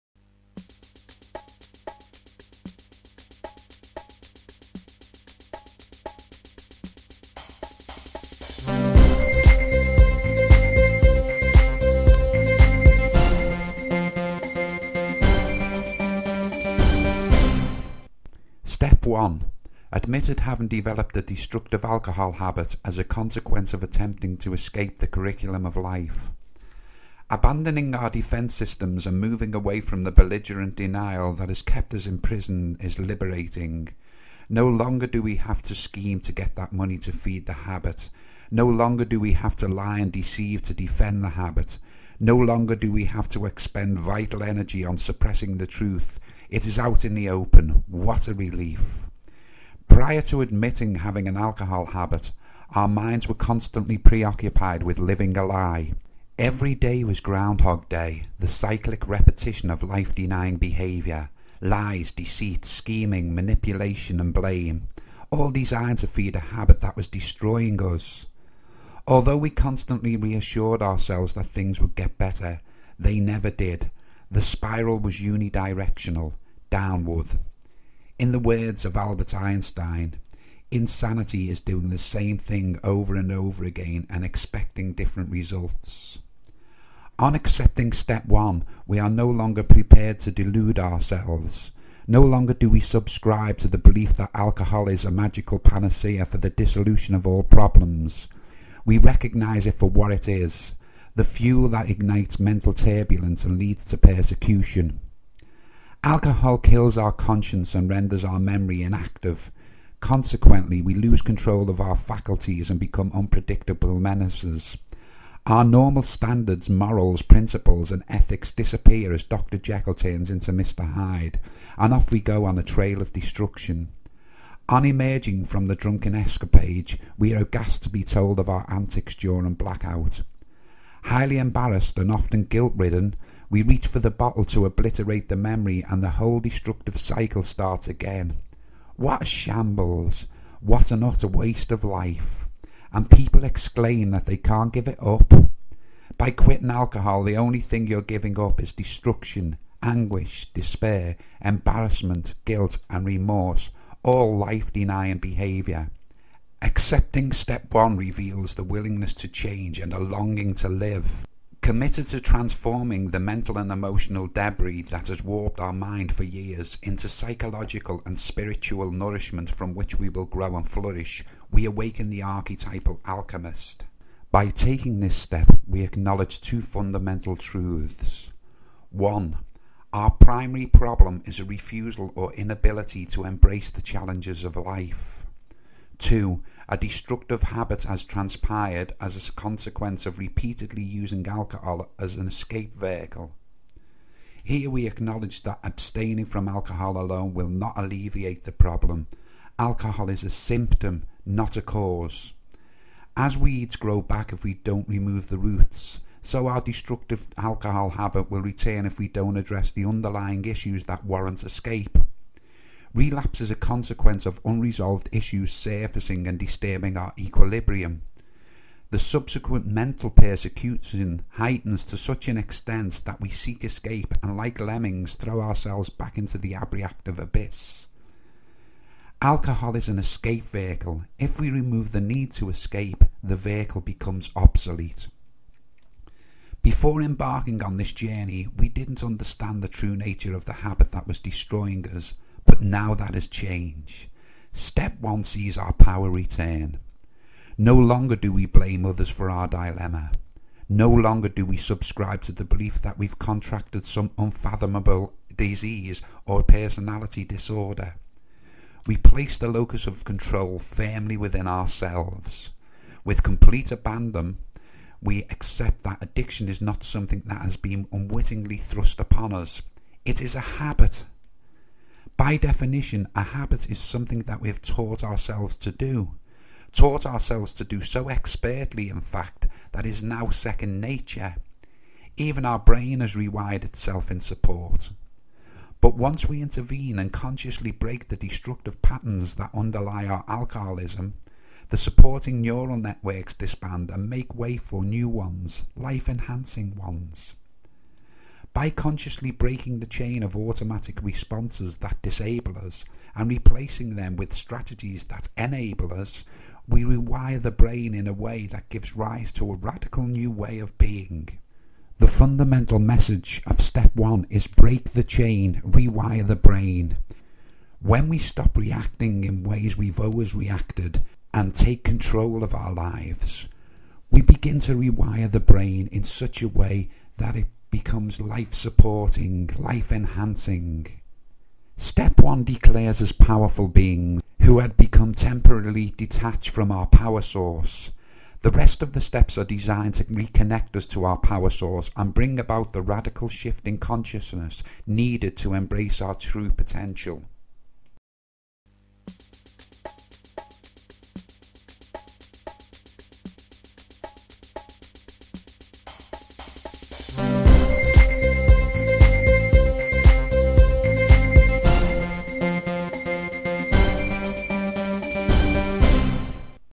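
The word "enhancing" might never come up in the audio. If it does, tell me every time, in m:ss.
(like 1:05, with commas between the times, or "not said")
4:56, 5:29.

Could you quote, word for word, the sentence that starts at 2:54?
By taking this step, we acknowledge two fundamental truths.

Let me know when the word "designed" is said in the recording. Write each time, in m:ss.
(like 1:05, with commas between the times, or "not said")
1:05, 5:39.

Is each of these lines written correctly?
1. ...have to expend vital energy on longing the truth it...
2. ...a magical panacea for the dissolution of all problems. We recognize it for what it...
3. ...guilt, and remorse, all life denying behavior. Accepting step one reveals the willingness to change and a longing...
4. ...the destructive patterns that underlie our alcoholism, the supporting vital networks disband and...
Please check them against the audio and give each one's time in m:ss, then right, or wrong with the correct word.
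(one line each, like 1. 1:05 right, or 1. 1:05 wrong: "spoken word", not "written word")
1. 0:43 wrong: "suppressing", not "longing"
2. 1:35 right
3. 2:32 right
4. 4:48 wrong: "neural", not "vital".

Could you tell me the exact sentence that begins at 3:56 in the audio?
Before embarking on this journey, we didn't understand the true nature of the habit that was destroying us now that has changed.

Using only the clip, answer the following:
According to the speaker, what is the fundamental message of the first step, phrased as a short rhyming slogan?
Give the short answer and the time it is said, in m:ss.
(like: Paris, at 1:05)
break the chain, rewire the brain, at 5:14.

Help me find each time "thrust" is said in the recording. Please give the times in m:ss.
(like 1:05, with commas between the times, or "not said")
4:28.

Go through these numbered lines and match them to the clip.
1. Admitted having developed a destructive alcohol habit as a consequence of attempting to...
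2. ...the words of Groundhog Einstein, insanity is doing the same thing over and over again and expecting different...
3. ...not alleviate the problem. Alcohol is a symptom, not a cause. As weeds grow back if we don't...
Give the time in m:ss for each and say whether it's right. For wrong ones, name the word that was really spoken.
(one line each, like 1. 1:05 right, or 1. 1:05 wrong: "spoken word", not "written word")
1. 0:19 right
2. 1:18 wrong: "Albert", not "Groundhog"
3. 3:17 right.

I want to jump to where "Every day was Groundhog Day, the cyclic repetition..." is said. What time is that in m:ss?
0:56.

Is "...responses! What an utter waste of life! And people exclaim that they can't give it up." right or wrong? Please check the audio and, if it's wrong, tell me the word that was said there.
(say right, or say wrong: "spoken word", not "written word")
wrong: "shambles", not "responses".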